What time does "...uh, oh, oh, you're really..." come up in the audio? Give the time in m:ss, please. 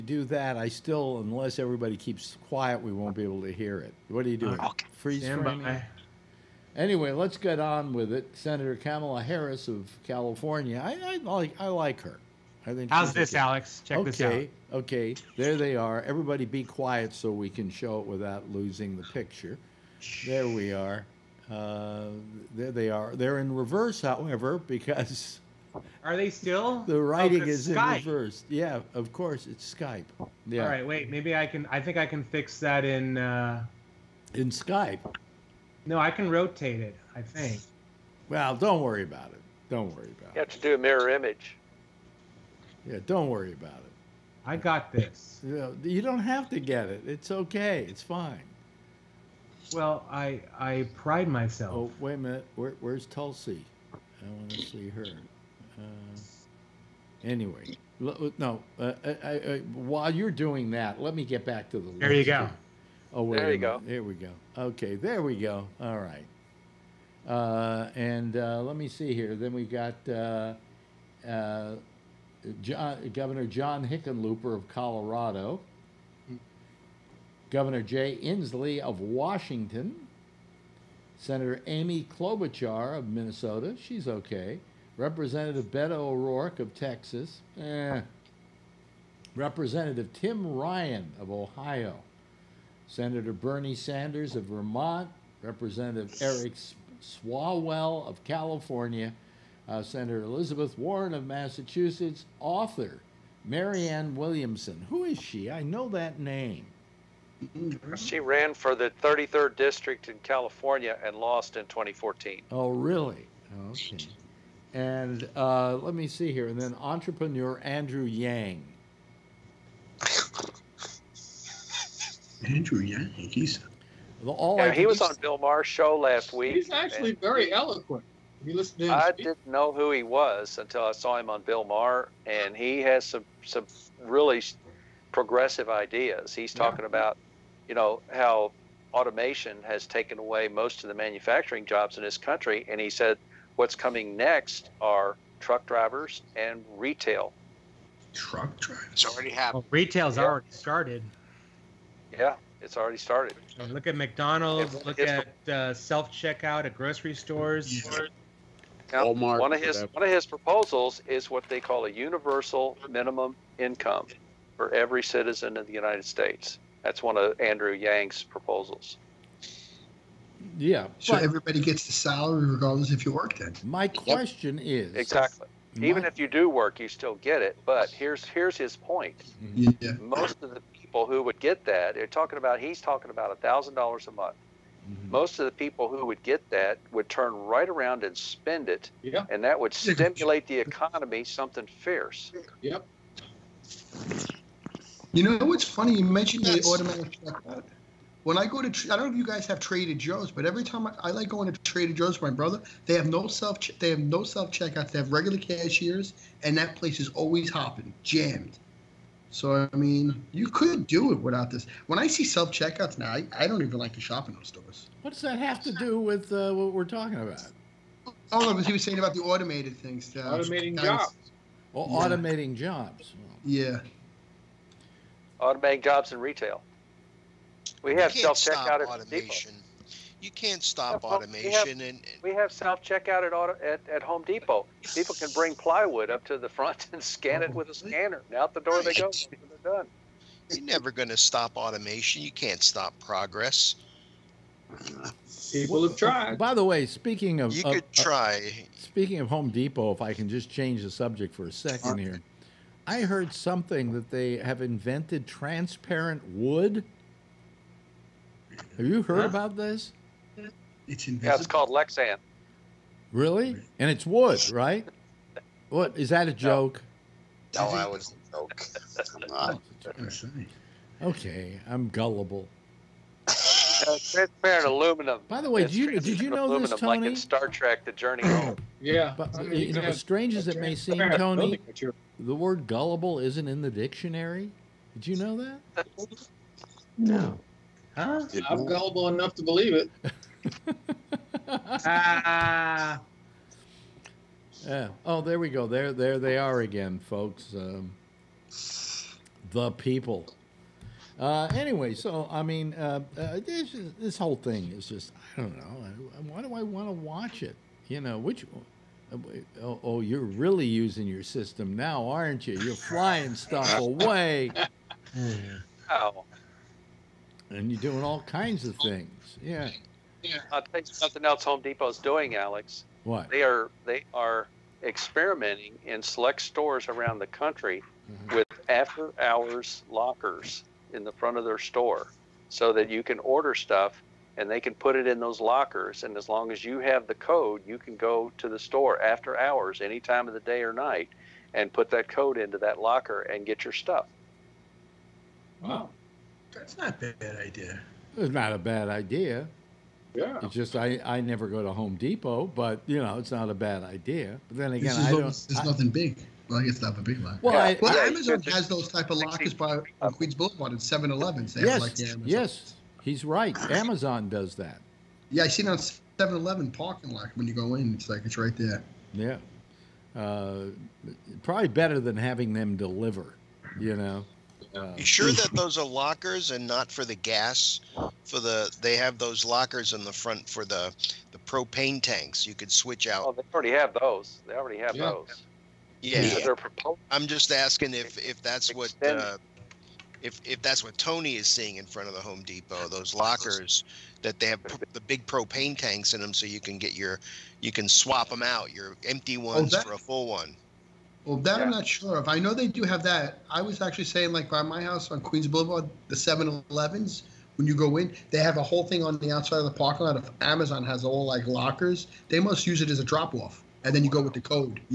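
5:09.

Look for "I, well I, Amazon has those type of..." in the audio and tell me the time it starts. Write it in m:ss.
5:57.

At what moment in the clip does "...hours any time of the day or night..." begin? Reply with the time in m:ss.
5:39.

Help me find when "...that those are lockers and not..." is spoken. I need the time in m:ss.
6:15.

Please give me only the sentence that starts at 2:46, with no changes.
That's one of Andrew Yang's proposals.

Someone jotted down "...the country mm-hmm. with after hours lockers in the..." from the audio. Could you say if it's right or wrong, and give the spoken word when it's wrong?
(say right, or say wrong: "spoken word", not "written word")
right.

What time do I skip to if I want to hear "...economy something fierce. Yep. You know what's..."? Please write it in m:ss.
3:10.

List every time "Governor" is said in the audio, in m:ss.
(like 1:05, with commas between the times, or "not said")
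1:13, 1:17.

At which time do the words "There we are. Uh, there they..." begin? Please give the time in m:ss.
0:20.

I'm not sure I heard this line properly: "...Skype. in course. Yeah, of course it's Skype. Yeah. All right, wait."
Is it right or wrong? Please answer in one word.
wrong.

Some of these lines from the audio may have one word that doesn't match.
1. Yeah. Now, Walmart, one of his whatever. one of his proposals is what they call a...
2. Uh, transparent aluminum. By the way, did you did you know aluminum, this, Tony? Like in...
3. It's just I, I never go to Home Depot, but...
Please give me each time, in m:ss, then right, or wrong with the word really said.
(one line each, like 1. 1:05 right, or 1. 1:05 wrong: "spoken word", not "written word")
1. 2:37 right
2. 4:33 right
3. 5:50 right.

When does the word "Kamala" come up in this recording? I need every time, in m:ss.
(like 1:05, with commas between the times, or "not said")
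0:08.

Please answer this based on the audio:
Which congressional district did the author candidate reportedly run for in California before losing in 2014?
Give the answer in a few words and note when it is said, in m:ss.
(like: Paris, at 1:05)
33rd district, at 1:49.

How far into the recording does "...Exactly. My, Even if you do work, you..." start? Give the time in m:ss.
2:54.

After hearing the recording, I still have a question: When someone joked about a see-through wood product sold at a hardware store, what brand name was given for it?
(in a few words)
Lexan.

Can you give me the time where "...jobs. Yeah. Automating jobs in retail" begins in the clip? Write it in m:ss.
3:42.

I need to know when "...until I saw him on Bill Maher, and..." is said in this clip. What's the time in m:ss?
2:10.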